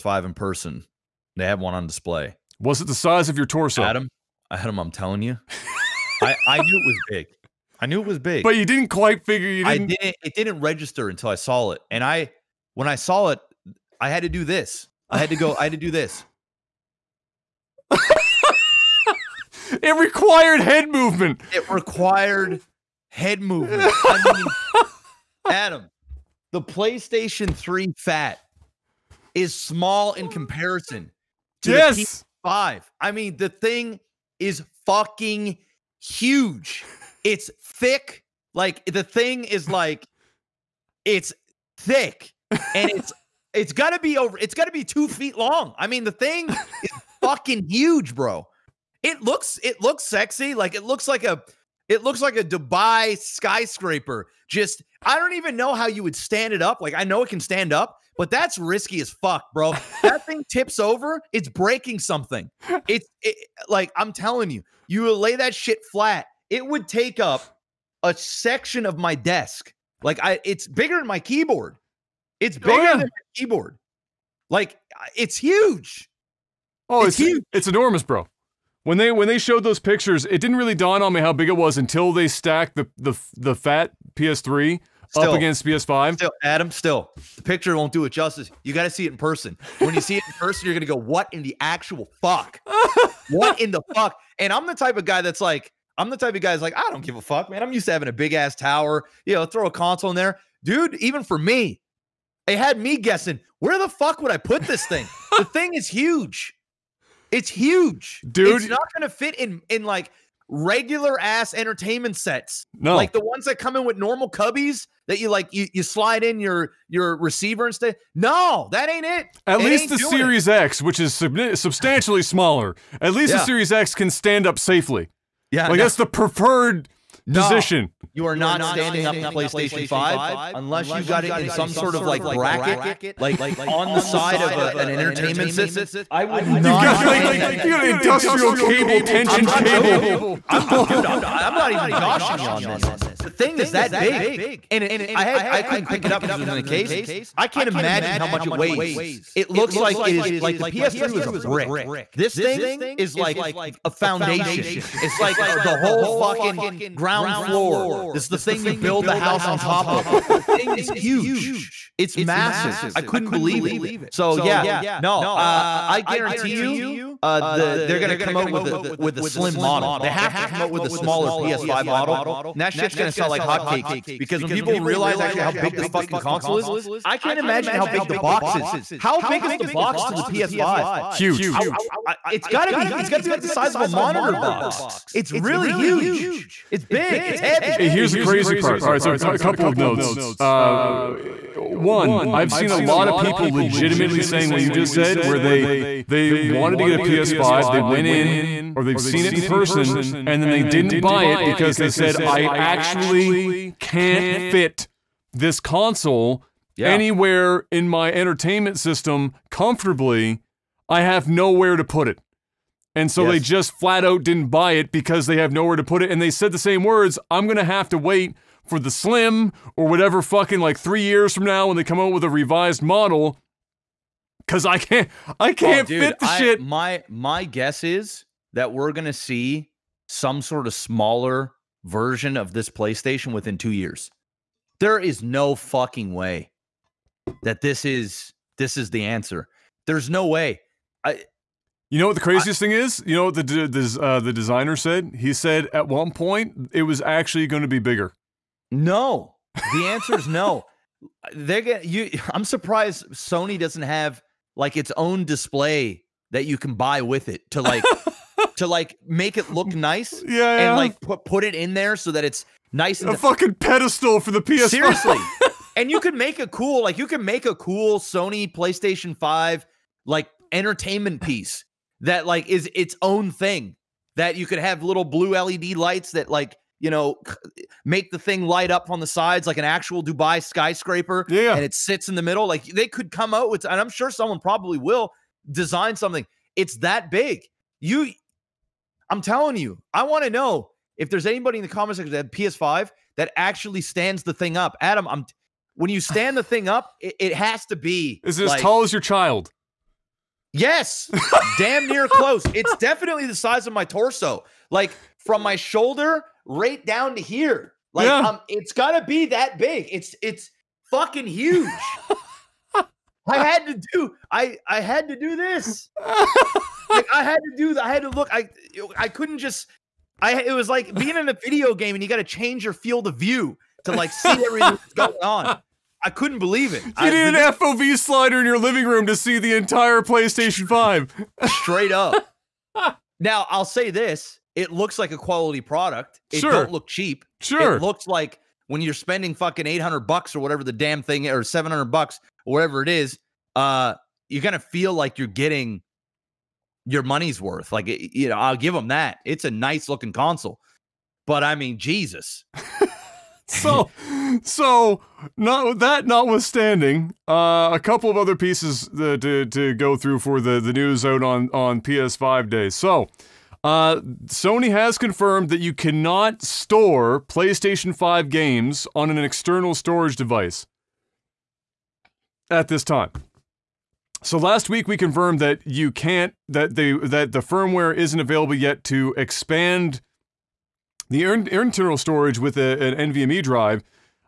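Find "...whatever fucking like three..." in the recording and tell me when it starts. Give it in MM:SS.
03:39.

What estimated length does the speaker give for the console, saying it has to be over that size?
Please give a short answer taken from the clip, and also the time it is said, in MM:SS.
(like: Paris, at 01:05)
two feet, at 00:44.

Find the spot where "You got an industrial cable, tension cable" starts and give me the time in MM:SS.
02:17.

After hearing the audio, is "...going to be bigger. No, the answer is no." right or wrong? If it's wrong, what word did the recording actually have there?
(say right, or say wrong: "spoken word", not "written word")
right.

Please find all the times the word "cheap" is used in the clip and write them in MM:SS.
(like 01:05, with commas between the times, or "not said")
05:36.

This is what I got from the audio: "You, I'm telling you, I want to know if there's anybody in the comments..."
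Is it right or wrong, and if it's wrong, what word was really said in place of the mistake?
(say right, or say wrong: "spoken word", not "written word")
right.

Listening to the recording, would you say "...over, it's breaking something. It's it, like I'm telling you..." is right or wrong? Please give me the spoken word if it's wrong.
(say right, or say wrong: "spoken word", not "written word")
right.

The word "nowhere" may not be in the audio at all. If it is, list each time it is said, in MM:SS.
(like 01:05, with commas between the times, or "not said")
03:31, 03:35.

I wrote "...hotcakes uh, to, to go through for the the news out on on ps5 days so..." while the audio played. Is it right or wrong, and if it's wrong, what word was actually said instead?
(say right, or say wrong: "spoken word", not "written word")
wrong: "pieces", not "hotcakes".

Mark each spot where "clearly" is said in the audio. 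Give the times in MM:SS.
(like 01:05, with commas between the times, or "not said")
not said.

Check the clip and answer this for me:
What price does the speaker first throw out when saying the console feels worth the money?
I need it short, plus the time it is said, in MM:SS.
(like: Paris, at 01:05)
$800, at 05:39.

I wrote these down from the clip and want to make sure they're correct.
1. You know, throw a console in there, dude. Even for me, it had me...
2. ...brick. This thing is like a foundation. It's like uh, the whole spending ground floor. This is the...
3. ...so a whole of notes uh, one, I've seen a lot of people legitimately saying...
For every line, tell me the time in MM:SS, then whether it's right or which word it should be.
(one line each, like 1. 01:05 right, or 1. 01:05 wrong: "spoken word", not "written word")
1. 01:39 right
2. 02:31 wrong: "fucking", not "spending"
3. 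03:09 wrong: "couple", not "whole".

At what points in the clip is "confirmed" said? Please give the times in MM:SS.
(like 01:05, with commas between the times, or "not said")
06:04, 06:14.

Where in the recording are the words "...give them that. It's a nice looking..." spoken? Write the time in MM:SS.
05:48.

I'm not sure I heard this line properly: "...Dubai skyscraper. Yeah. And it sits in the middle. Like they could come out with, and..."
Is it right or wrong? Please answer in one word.
right.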